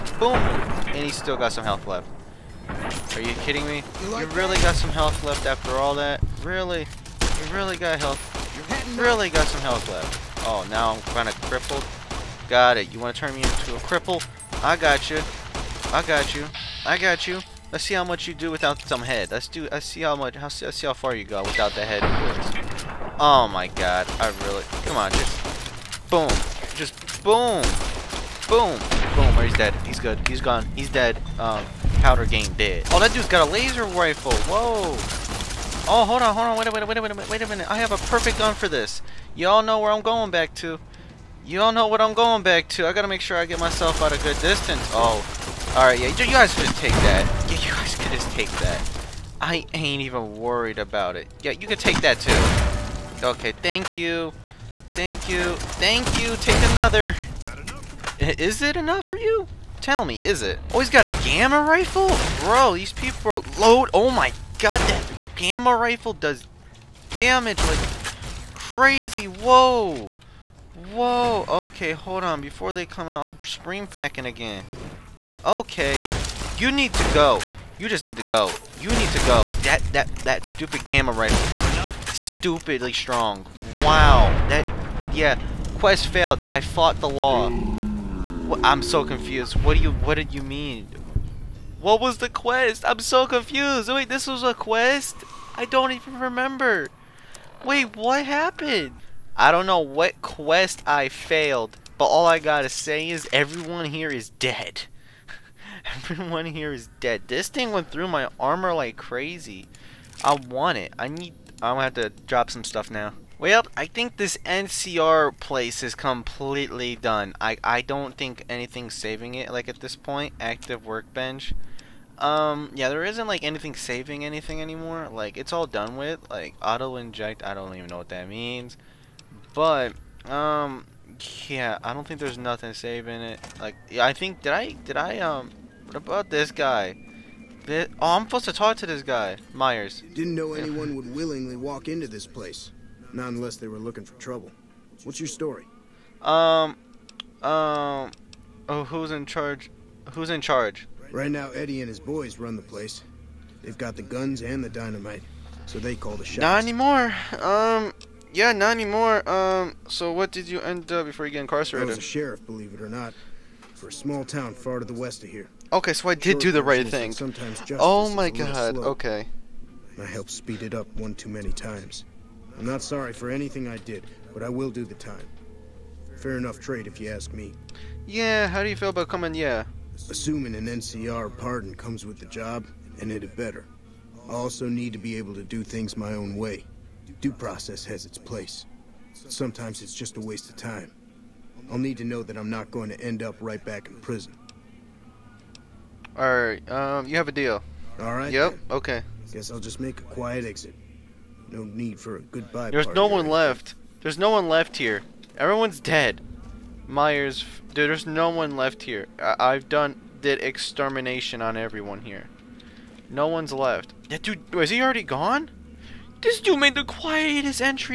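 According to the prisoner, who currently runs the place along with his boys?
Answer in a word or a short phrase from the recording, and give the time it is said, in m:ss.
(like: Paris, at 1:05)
Eddie, at 2:31.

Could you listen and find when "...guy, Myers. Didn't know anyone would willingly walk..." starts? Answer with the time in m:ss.
2:19.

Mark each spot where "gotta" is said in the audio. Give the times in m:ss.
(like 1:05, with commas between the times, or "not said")
0:42, 1:42.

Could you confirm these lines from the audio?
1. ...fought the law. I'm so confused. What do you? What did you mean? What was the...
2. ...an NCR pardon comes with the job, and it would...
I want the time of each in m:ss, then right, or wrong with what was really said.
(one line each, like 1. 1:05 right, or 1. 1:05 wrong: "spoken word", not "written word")
1. 1:26 right
2. 3:00 right.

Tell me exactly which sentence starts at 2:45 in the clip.
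Okay, so I did Short do the right thing.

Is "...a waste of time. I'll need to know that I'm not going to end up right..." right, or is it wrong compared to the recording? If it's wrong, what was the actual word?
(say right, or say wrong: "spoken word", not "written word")
right.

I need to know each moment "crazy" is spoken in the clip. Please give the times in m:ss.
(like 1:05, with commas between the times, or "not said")
1:08, 1:48.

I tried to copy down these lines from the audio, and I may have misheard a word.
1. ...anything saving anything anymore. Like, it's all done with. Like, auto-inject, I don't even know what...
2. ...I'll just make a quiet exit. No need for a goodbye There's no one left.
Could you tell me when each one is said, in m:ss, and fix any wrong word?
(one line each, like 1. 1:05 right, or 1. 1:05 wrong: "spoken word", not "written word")
1. 2:03 right
2. 3:19 right.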